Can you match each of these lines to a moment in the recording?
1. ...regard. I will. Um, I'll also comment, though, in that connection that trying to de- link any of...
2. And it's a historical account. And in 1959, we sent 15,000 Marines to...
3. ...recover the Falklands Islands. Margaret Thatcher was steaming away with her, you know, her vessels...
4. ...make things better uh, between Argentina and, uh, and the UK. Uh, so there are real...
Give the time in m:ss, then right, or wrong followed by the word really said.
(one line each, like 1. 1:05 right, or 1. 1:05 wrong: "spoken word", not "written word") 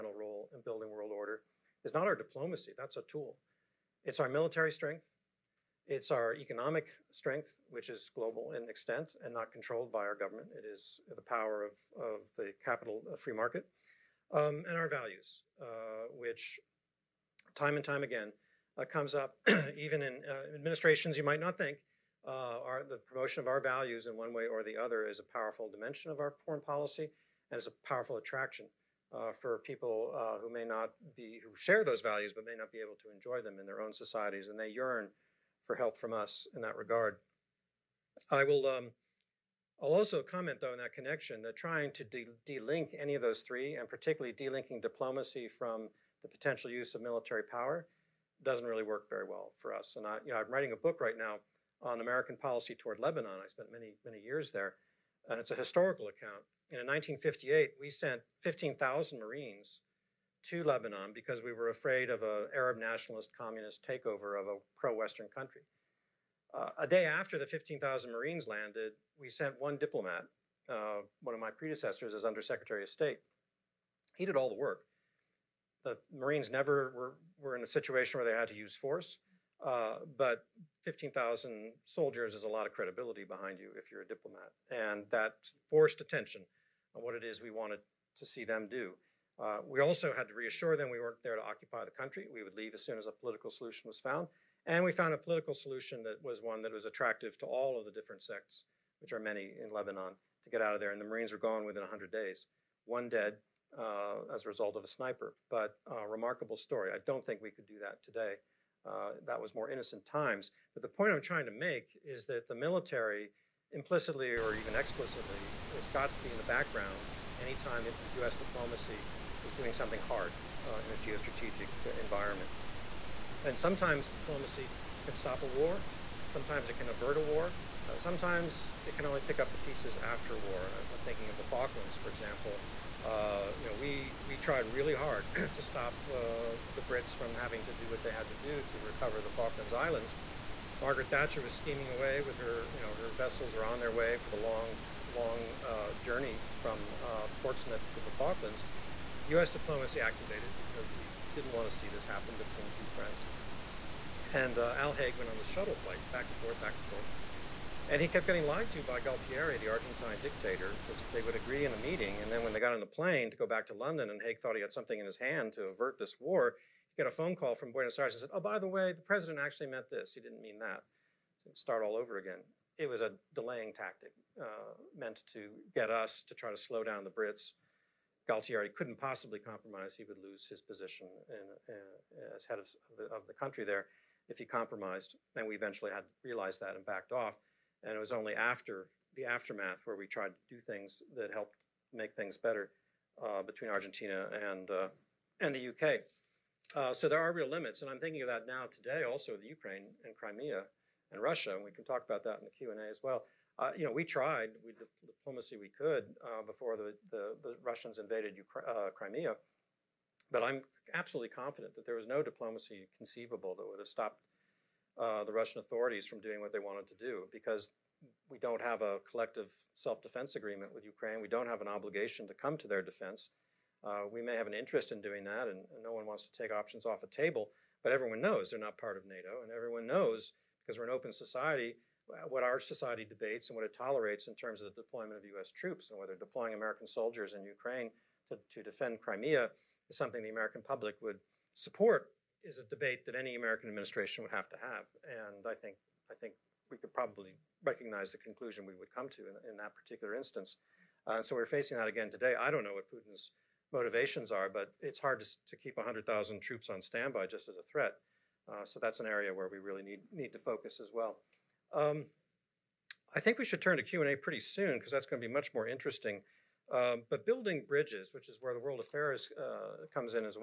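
1. 0:36 right
2. 0:55 wrong: "1958", not "1959"
3. 2:18 right
4. 3:11 right.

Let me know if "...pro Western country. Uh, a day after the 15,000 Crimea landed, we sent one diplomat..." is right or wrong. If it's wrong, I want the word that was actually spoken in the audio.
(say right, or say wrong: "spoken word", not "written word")
wrong: "Marines", not "Crimea".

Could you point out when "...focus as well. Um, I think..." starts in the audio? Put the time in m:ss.
4:20.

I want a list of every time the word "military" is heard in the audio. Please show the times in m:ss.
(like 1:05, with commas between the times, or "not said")
0:04, 0:47, 1:52.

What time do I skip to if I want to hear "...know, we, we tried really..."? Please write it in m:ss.
2:13.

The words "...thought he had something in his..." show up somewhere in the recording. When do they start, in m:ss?
2:44.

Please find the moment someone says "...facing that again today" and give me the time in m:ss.
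4:11.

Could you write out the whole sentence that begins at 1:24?
And that forced attention on what it is we wanted to see them do.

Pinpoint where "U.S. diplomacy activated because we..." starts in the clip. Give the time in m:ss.
2:29.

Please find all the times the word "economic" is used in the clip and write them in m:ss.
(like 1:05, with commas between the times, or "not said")
0:06.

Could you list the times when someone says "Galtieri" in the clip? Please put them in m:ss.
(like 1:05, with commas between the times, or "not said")
2:39, 2:58.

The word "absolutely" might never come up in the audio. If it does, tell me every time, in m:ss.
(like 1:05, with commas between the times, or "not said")
3:30.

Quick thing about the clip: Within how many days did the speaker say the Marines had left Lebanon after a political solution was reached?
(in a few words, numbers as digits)
100 days.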